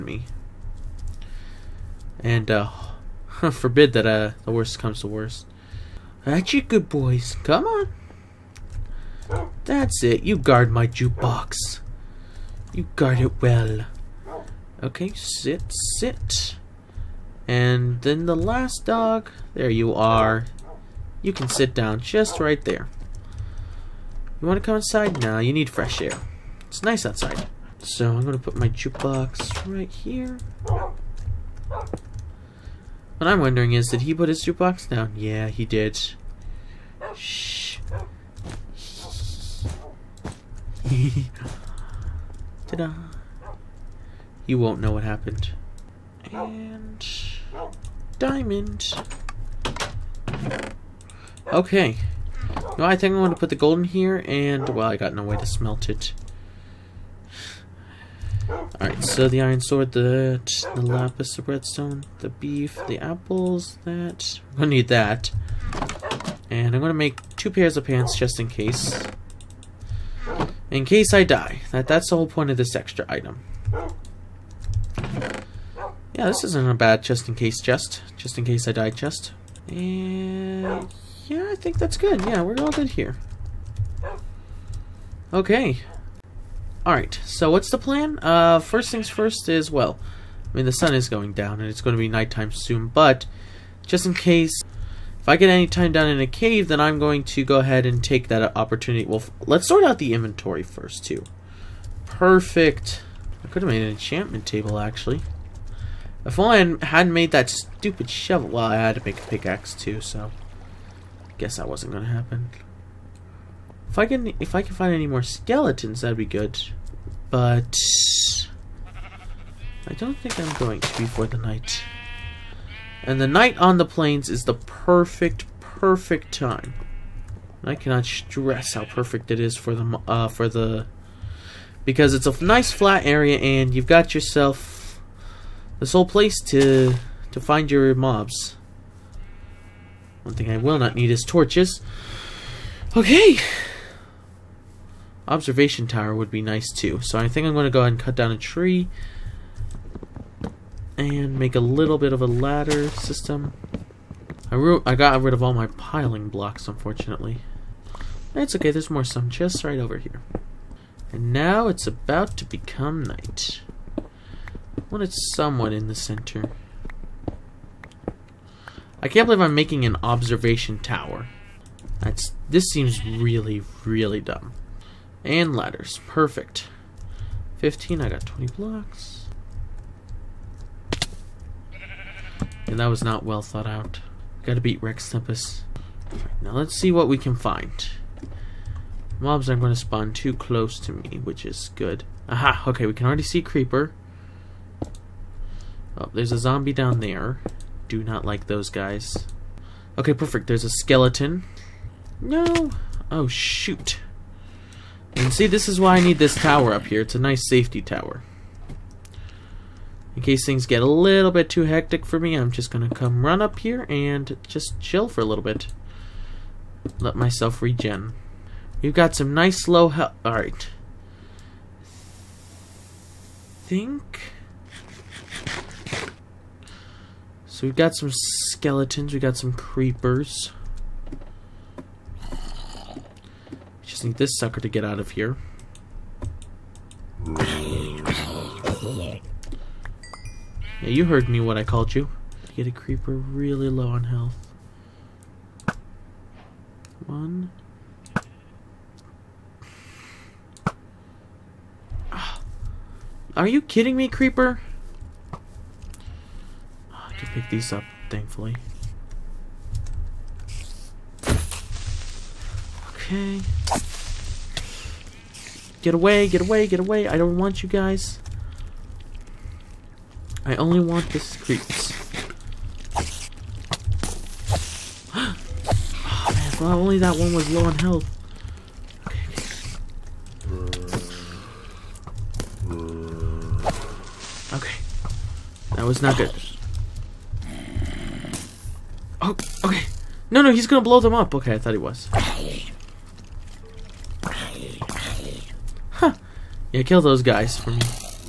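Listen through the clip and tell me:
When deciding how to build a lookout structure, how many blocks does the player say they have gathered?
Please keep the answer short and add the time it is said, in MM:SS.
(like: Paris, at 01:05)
20, at 02:58.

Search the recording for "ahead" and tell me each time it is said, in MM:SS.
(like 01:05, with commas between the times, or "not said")
01:37, 02:27.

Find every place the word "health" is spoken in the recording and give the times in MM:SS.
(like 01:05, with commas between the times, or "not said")
03:39, 04:04, 04:37.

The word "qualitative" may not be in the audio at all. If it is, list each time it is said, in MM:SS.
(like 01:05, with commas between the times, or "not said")
not said.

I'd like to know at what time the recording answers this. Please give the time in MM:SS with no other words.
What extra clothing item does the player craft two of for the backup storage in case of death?
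01:07.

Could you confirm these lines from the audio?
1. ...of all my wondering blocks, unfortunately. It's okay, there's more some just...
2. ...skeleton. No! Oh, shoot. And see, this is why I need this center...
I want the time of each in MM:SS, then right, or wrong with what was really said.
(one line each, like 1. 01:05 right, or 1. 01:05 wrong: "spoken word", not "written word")
1. 02:35 wrong: "piling", not "wondering"
2. 03:20 wrong: "tower", not "center".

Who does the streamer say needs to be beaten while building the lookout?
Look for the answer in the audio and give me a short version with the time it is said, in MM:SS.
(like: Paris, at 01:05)
RexTempus, at 03:04.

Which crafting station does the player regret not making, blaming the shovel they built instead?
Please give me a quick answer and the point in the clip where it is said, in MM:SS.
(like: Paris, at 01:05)
enchantment table, at 01:43.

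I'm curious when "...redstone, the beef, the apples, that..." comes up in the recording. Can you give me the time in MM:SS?
01:01.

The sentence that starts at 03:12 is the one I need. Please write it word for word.
Aha, okay, we can already see Creeper.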